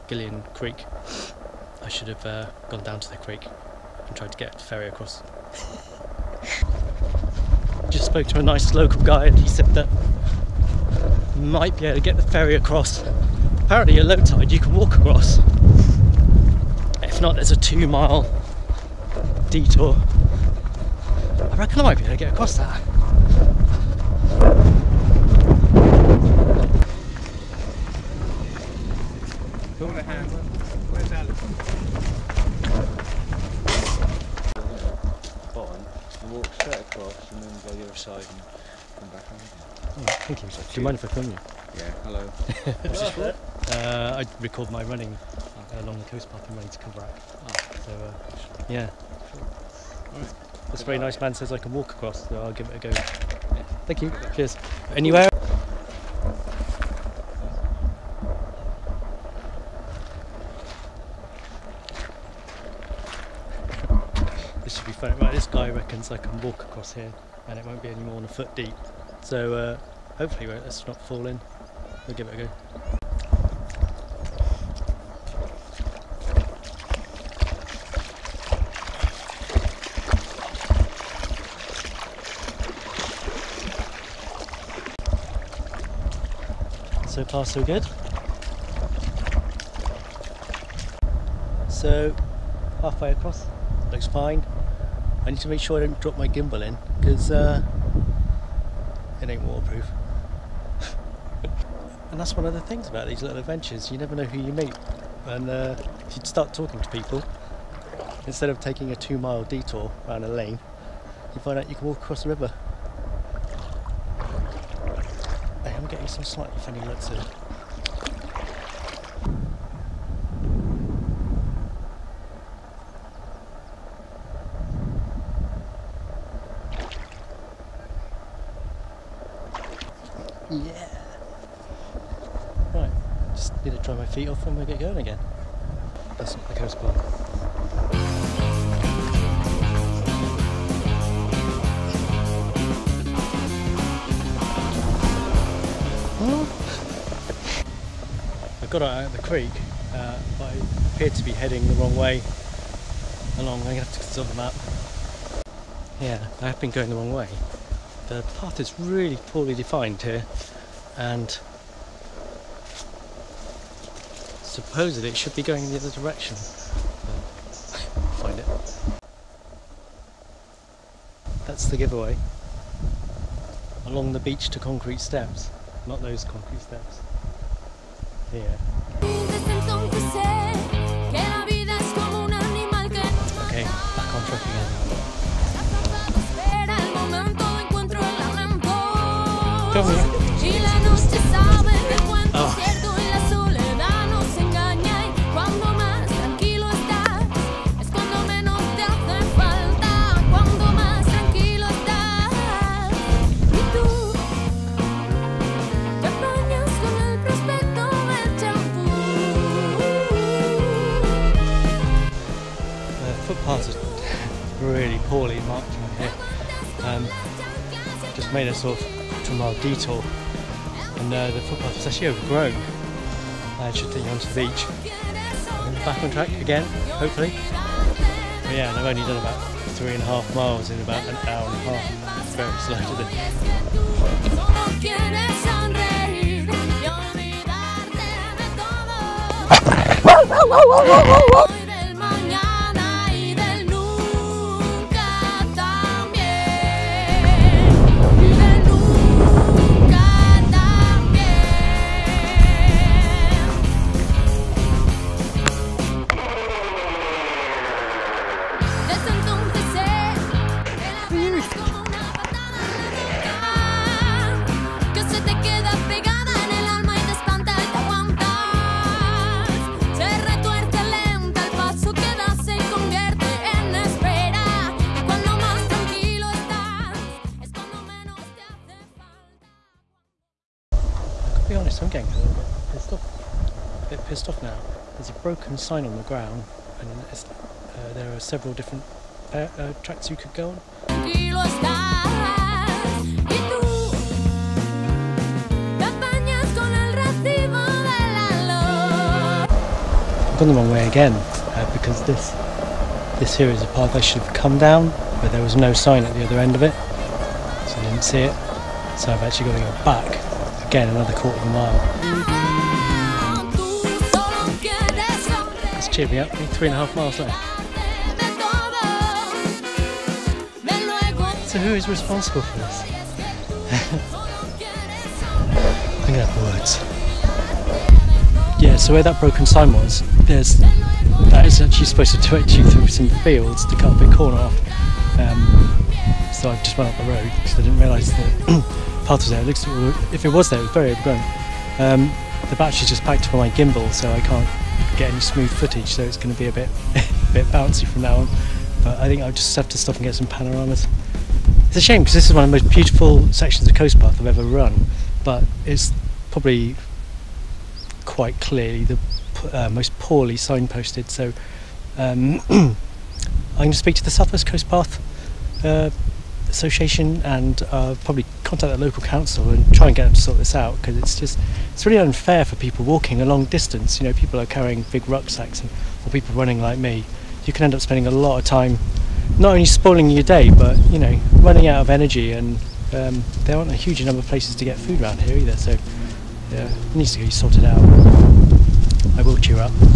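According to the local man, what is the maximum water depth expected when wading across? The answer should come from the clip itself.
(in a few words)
1 foot.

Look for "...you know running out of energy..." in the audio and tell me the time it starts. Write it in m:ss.
6:20.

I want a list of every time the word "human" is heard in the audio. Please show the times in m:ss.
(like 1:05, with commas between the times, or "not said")
not said.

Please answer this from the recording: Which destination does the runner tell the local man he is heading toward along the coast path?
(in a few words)
Coverack.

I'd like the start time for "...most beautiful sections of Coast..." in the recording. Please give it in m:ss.
5:52.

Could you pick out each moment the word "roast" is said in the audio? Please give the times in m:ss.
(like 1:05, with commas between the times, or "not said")
not said.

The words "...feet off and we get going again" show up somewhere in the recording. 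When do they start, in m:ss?
2:14.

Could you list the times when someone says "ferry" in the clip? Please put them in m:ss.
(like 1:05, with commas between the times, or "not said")
0:04, 0:12.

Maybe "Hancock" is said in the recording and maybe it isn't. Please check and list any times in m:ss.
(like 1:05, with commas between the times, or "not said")
not said.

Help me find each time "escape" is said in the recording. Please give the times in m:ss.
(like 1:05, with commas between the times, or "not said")
not said.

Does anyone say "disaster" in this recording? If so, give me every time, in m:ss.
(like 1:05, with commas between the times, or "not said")
not said.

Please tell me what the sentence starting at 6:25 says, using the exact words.
So yeah, it needs to be sorted out.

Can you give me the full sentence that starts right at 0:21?
I reckon I might be able to get across that.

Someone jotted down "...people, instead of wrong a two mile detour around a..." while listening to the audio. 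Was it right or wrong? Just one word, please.
wrong.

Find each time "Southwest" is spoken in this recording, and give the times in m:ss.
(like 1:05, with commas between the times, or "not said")
6:04.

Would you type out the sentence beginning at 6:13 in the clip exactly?
You know, people are carrying big rucksacks and, or people running like me.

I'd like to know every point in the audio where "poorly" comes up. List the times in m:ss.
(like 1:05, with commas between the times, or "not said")
2:39, 5:59.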